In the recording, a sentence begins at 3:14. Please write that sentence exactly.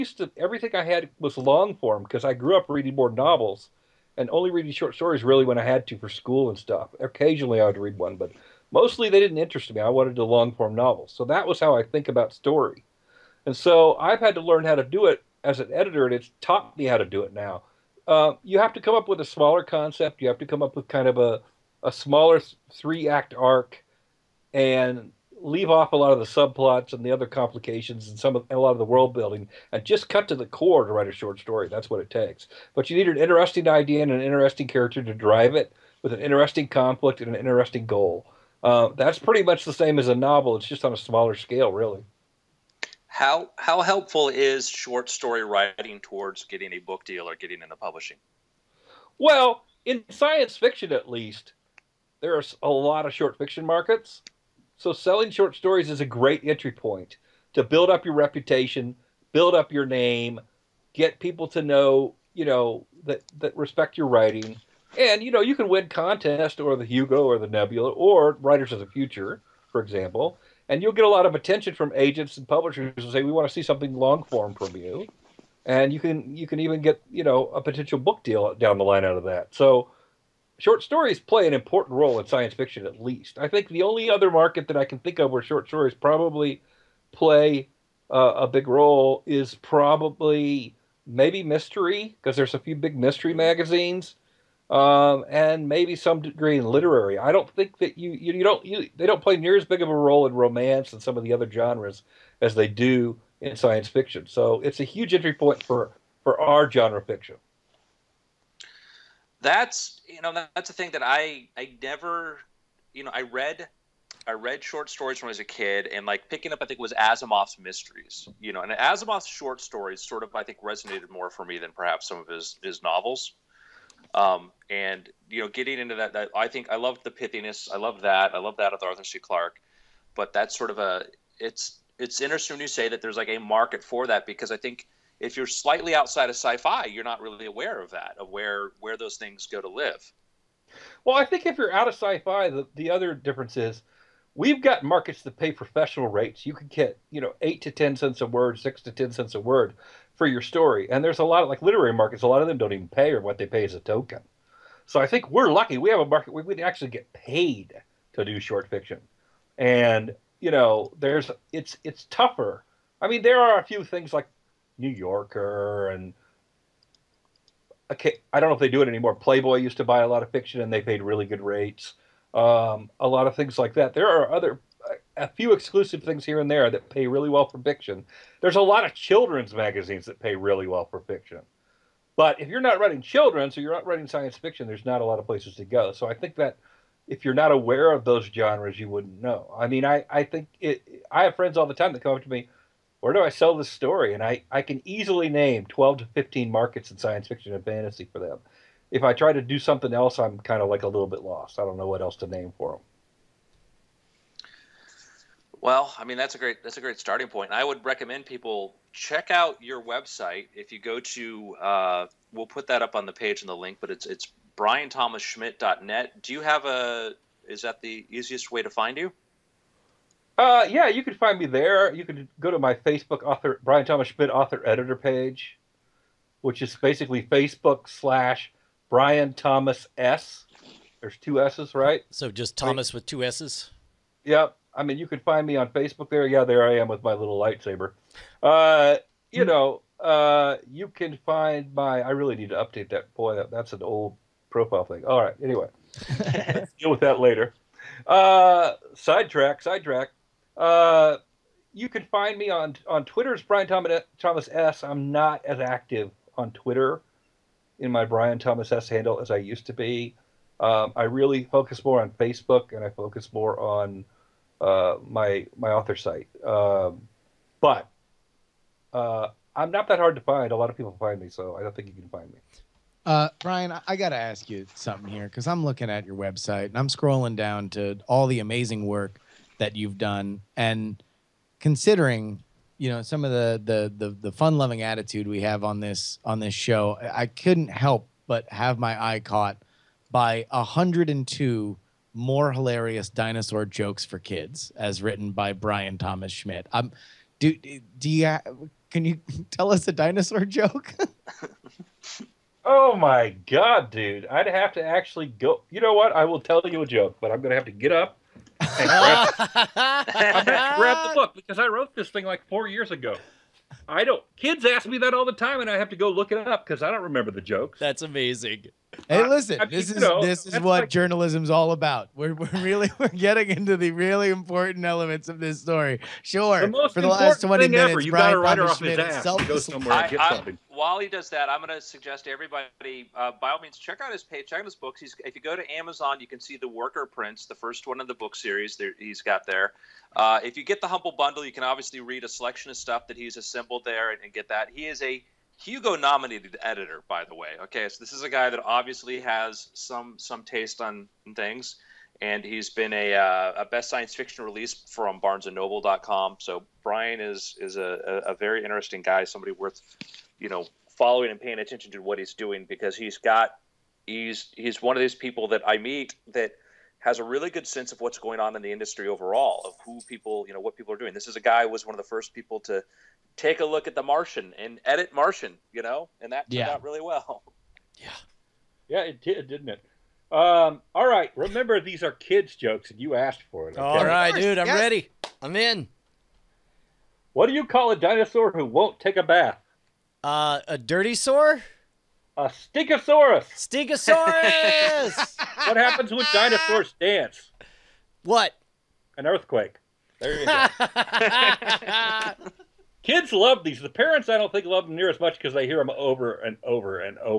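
And I, I can easily name 12 to 15 markets in science fiction and fantasy for them.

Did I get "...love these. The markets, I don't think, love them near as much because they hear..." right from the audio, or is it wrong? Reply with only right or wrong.
wrong.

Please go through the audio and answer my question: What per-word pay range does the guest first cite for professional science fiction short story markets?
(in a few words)
8 to 10 cents a word.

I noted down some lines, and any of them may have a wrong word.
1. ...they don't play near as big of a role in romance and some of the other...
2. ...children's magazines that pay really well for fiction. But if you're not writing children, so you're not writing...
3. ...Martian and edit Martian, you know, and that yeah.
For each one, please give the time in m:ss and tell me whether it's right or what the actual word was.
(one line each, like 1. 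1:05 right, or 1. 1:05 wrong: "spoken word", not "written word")
1. 1:38 right
2. 2:58 right
3. 6:14 right.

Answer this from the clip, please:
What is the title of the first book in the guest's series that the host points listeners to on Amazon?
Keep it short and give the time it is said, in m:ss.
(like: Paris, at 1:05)
The Worker Prince, at 5:36.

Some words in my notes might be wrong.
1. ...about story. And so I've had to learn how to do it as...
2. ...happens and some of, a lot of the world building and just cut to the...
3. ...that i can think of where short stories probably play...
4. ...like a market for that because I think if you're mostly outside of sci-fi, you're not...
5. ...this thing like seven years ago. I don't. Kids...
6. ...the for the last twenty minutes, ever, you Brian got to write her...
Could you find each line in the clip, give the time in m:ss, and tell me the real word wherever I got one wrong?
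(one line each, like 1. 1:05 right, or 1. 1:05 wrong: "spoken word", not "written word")
1. 0:12 right
2. 0:27 wrong: "complications", not "happens"
3. 1:24 right
4. 2:13 wrong: "slightly", not "mostly"
5. 5:11 wrong: "four", not "seven"
6. 5:26 right.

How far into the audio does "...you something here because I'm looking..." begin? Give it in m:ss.
4:34.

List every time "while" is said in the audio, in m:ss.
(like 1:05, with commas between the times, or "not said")
5:30.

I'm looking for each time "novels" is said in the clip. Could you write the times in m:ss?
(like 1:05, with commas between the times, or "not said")
0:03, 0:10, 0:40, 2:02.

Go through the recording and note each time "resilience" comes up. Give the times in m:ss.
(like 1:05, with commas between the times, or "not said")
not said.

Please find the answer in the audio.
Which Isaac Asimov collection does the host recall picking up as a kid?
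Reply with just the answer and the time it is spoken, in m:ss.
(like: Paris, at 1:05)
Asimov's Mysteries, at 1:56.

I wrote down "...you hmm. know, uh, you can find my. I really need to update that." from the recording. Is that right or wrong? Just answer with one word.
right.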